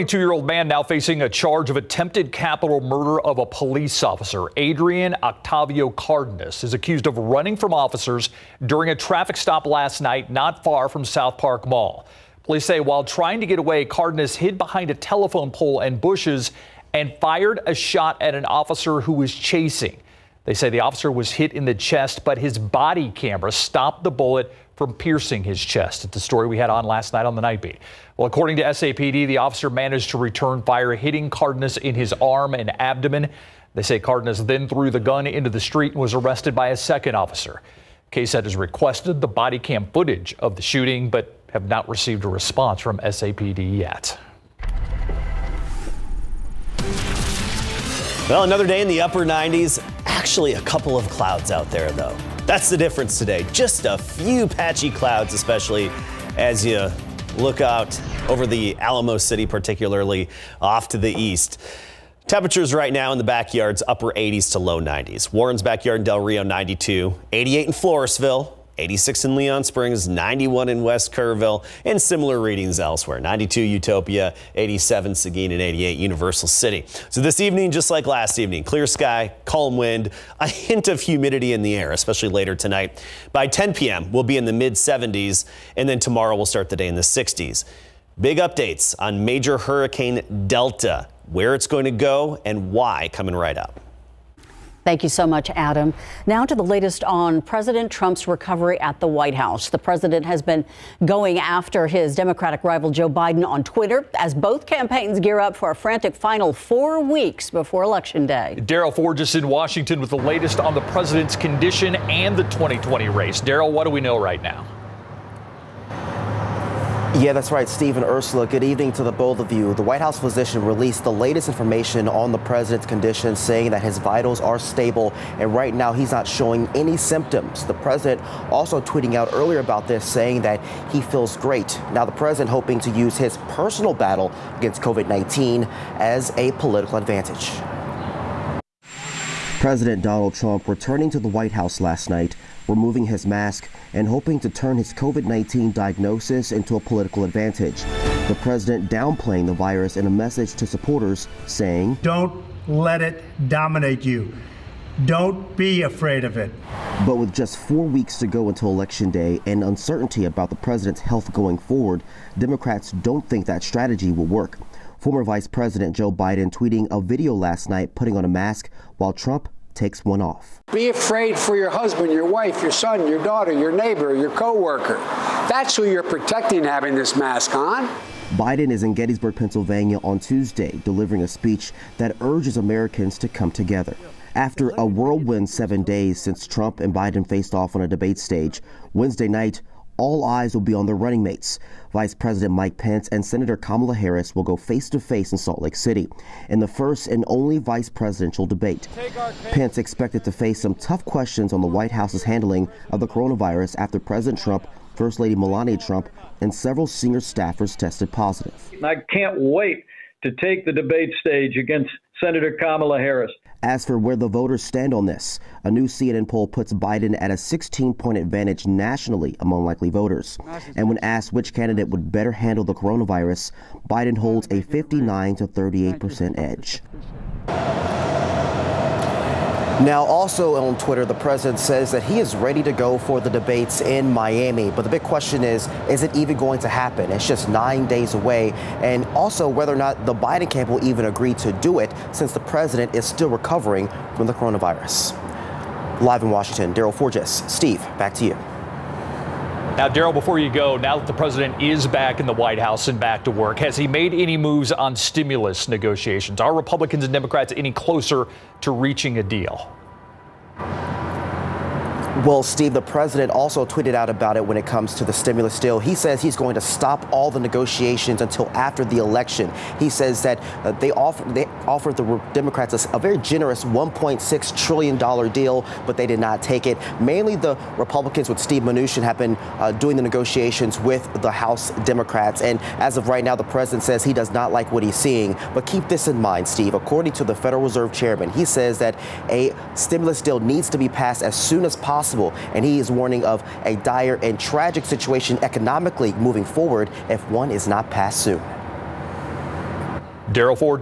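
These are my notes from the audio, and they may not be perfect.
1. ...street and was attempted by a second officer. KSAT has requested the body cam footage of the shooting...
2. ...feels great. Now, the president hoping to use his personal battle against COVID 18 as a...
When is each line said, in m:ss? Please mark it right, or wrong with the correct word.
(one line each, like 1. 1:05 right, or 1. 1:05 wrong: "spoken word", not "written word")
1. 0:35 wrong: "arrested", not "attempted"
2. 2:11 wrong: "19", not "18".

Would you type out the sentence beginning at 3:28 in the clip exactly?
I can't wait to take the debate stage against Senator Kamala Harris.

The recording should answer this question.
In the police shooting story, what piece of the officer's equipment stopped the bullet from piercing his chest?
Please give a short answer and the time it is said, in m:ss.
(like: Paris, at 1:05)
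body camera, at 0:22.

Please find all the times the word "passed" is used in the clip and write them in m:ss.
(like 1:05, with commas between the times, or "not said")
4:50, 4:57.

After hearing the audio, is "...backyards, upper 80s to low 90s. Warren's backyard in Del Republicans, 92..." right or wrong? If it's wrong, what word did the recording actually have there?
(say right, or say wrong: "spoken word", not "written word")
wrong: "Rio", not "Republicans".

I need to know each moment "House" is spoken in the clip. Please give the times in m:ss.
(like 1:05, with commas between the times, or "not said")
1:39, 1:59, 2:21, 3:21, 4:12, 4:41.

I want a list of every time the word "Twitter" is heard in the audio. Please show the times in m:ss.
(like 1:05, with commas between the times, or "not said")
1:43, 3:50.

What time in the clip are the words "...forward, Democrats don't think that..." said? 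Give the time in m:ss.
2:41.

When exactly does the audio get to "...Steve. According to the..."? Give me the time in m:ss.
4:46.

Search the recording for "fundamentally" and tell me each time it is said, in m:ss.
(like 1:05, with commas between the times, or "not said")
not said.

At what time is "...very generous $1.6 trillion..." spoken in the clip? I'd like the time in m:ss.
4:32.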